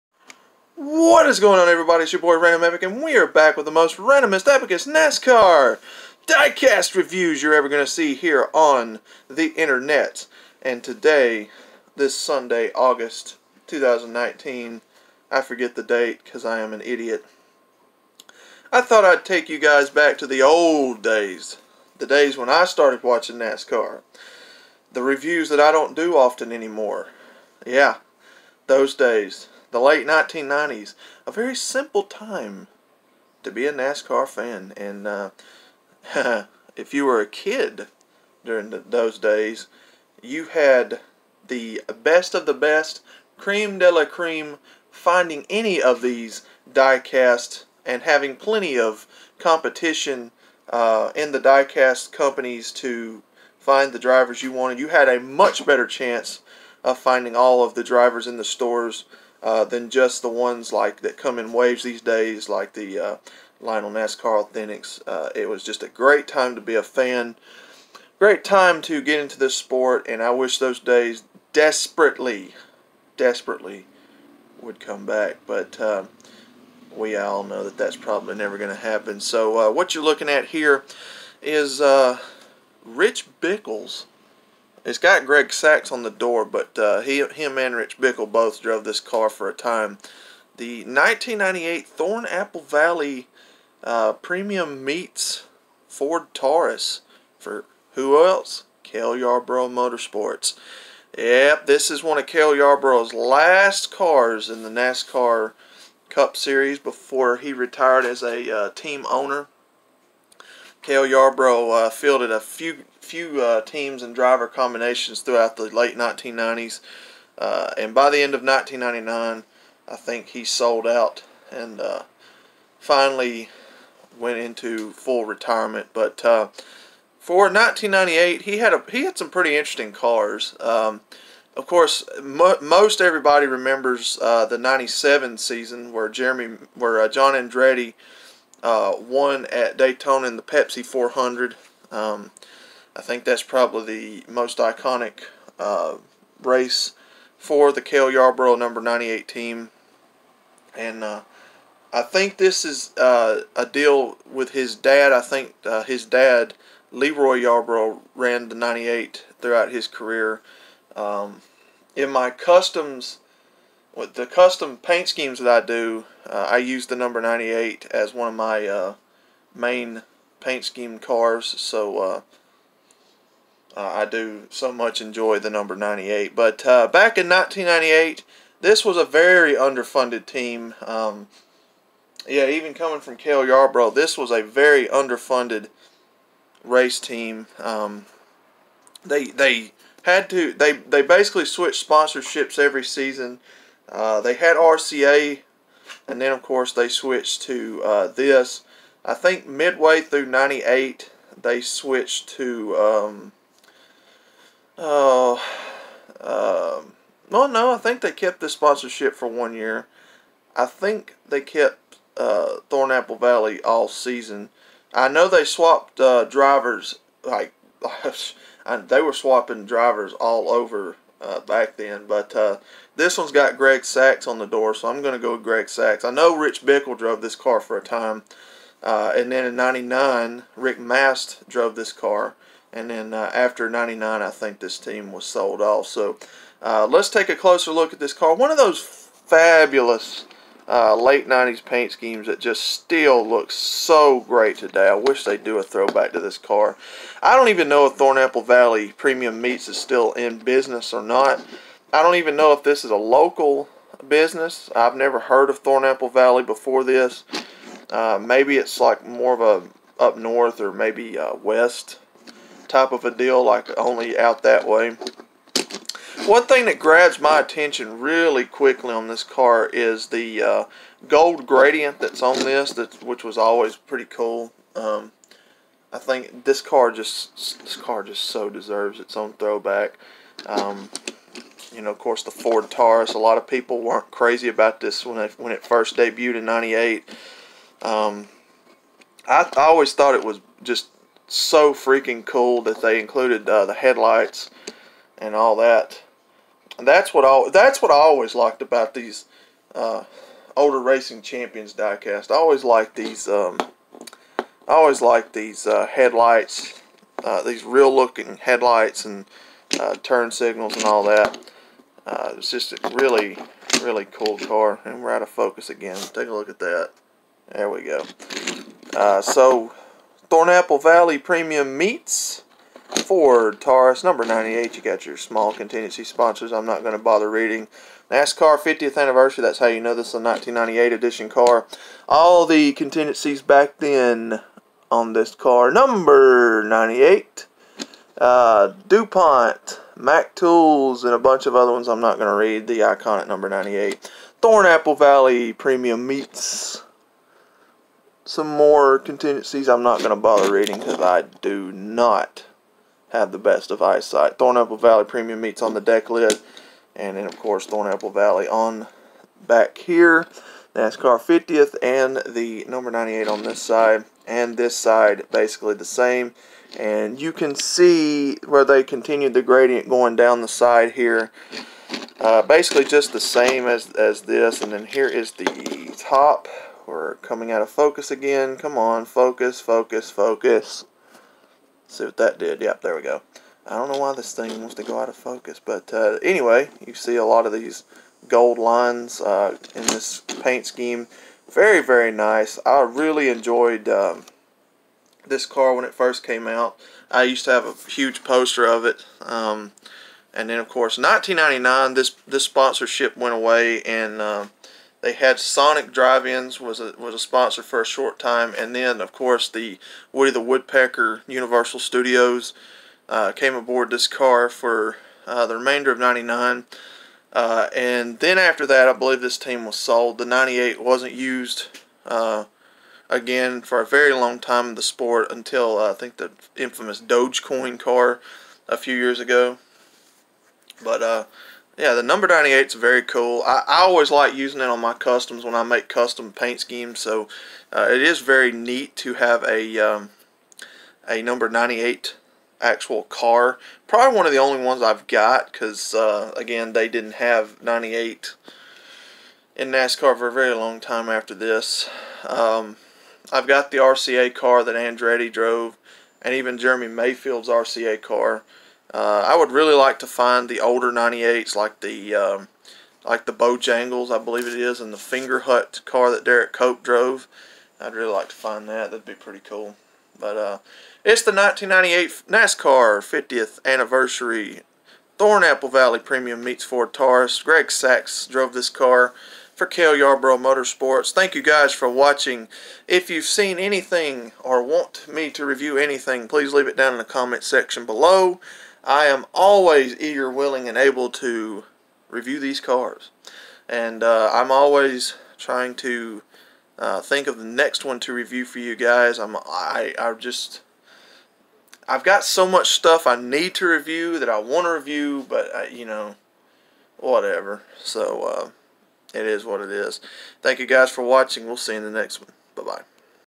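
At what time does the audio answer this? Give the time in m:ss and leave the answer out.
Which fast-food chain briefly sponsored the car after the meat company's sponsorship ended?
6:45.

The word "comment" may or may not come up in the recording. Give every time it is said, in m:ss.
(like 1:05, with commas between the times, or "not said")
8:07.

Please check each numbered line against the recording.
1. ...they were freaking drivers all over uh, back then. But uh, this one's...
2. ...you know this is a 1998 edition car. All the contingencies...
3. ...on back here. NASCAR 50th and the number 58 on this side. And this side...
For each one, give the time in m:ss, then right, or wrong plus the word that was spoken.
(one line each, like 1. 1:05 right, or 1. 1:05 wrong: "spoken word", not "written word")
1. 3:38 wrong: "swapping", not "freaking"
2. 5:29 right
3. 5:58 wrong: "98", not "58".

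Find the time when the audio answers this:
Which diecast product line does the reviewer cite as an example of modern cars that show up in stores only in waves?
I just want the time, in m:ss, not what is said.
1:03.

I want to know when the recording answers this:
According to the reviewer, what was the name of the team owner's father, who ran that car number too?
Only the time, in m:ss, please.
2:36.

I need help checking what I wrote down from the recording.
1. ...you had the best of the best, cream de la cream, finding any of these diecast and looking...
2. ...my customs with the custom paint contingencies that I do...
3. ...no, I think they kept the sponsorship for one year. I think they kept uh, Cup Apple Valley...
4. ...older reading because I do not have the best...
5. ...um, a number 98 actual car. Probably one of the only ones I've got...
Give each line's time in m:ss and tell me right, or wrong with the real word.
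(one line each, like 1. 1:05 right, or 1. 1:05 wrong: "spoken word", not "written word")
1. 0:40 wrong: "having", not "looking"
2. 2:42 wrong: "schemes", not "contingencies"
3. 3:27 wrong: "Thorn", not "Cup"
4. 5:50 wrong: "bother", not "older"
5. 7:19 right.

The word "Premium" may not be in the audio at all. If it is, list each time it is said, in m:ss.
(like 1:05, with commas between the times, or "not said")
1:34, 4:08, 5:21, 5:45, 5:55, 7:55.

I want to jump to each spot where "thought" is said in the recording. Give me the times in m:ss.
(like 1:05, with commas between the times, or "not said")
0:18, 4:49.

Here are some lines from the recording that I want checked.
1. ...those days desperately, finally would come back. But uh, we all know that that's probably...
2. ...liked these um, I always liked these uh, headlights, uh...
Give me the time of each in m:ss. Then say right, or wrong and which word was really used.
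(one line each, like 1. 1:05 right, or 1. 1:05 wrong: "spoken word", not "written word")
1. 1:10 wrong: "desperately", not "finally"
2. 5:02 right.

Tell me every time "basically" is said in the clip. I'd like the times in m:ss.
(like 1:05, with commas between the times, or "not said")
3:11, 6:05, 6:12.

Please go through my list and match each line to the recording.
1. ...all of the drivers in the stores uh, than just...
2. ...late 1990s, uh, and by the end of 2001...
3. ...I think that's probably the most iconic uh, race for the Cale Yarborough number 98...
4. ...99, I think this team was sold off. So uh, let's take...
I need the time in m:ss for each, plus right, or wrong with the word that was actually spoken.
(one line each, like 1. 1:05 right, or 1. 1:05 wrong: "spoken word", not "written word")
1. 0:57 right
2. 1:55 wrong: "1999", not "2001"
3. 2:22 right
4. 3:53 right.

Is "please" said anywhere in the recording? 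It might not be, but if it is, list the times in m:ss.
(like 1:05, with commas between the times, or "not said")
8:06.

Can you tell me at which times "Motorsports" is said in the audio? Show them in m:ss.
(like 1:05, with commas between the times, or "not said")
1:39, 8:00.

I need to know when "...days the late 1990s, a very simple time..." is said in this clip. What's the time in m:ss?
0:28.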